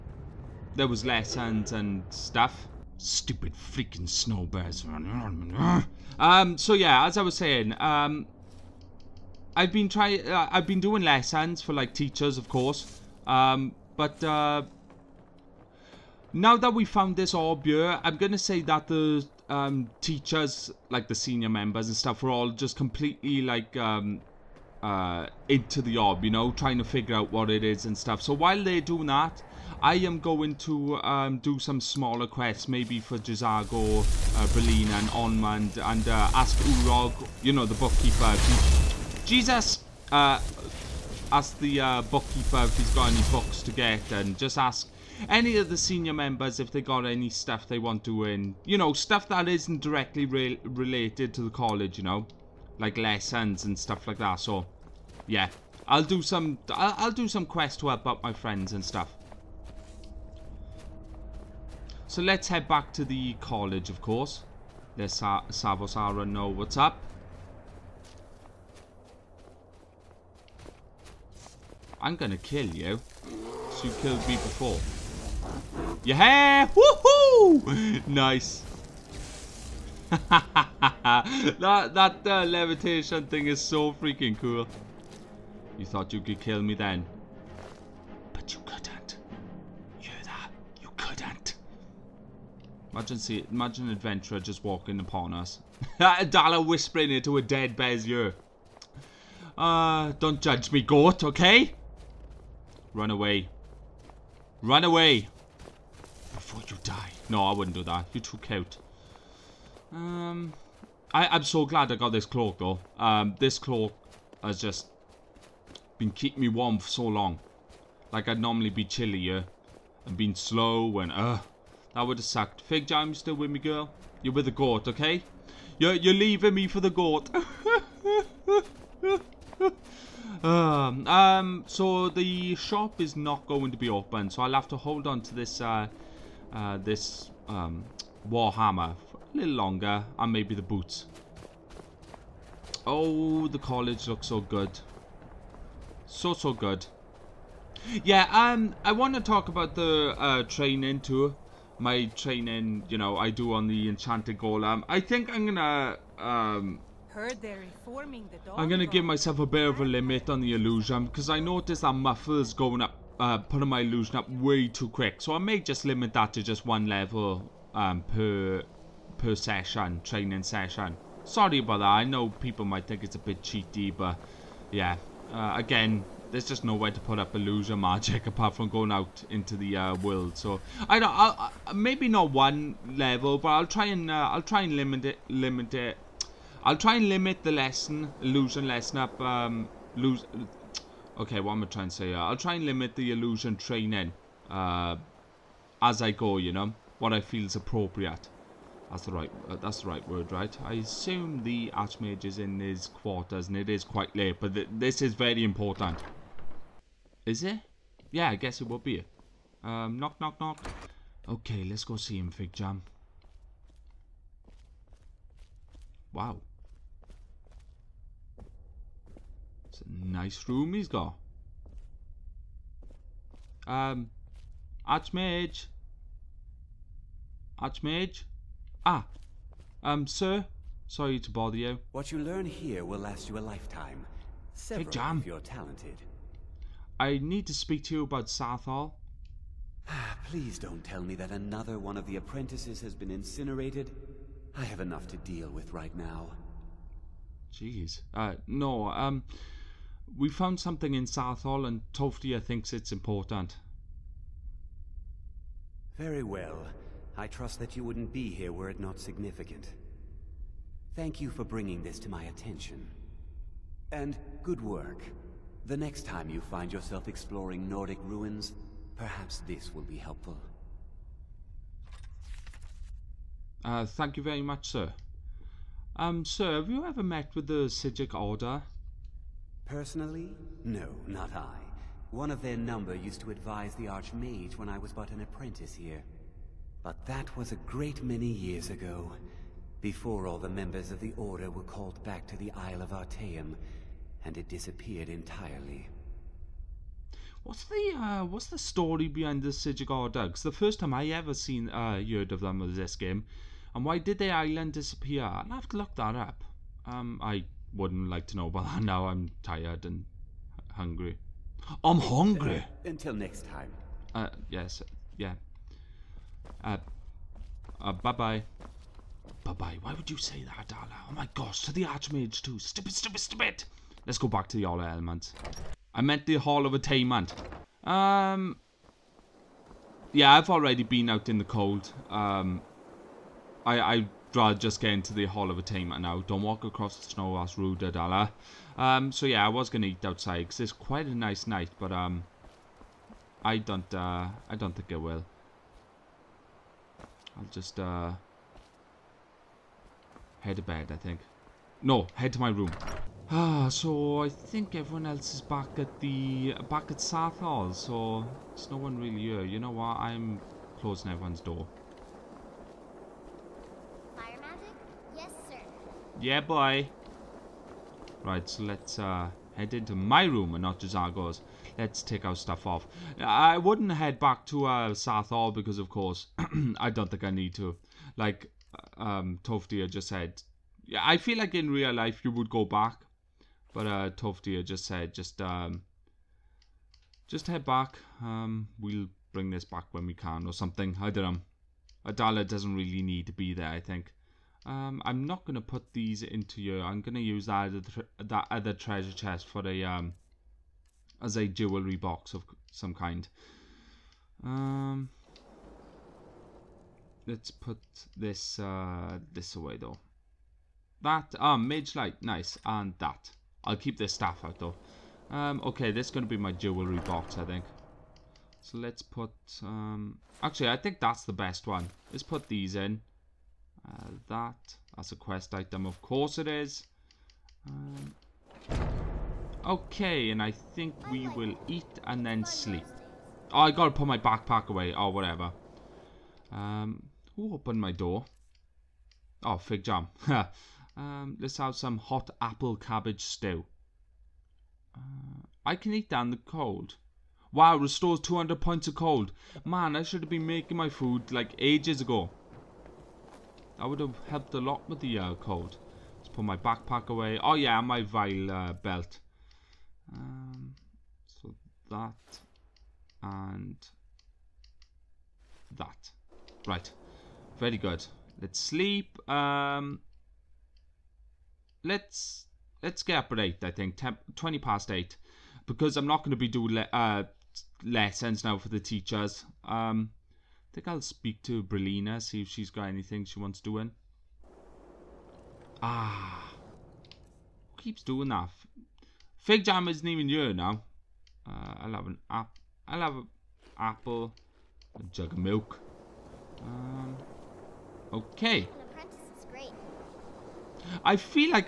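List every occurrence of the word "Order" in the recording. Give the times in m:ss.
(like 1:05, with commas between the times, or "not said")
4:38, 4:51.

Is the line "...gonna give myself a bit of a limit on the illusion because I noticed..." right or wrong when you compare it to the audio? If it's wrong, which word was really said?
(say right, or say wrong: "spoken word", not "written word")
right.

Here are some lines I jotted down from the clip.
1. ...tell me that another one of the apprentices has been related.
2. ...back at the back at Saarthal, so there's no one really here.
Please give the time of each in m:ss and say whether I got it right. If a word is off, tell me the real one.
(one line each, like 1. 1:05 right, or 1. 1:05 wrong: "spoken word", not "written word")
1. 4:00 wrong: "incinerated", not "related"
2. 5:55 right.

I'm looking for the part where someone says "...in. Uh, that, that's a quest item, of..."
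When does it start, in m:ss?
7:02.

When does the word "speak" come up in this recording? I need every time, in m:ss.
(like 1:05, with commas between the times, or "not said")
3:57, 8:01.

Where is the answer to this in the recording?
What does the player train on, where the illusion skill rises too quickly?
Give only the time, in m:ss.
2:33.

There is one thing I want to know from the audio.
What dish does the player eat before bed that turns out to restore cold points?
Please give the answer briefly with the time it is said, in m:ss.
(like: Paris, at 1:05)
Hot apple cabbage stew, at 7:21.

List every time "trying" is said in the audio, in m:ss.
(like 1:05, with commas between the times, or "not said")
0:09, 0:26, 3:11.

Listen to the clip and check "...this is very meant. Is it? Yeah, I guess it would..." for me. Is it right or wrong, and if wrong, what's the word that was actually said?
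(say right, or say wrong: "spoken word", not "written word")
wrong: "important", not "meant".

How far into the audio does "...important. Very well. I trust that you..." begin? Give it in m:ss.
4:12.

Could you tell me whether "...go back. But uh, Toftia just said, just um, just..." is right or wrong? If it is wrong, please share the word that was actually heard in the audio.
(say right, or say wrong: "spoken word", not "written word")
right.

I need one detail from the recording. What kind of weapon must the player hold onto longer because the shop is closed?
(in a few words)
Warhammer.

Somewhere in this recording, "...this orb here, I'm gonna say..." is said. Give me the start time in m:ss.
0:17.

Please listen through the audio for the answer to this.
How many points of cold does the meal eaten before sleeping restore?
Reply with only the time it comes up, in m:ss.
7:28.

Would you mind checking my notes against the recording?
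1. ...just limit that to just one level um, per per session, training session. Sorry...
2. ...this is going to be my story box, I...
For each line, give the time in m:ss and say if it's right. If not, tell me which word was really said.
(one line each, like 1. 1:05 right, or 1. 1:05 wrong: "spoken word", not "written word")
1. 2:45 right
2. 6:55 wrong: "jewelry", not "story".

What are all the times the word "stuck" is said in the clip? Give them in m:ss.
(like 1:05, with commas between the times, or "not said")
not said.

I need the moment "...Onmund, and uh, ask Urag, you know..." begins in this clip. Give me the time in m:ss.
0:35.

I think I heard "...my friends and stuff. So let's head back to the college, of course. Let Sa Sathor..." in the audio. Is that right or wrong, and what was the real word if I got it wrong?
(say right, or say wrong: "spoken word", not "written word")
wrong: "Savos", not "Sathor".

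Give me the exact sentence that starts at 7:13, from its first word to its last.
Oh, I gotta put my backpack away, or oh, whatever.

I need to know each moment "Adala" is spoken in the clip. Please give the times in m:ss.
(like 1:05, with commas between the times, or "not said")
1:35, 5:37, 6:32.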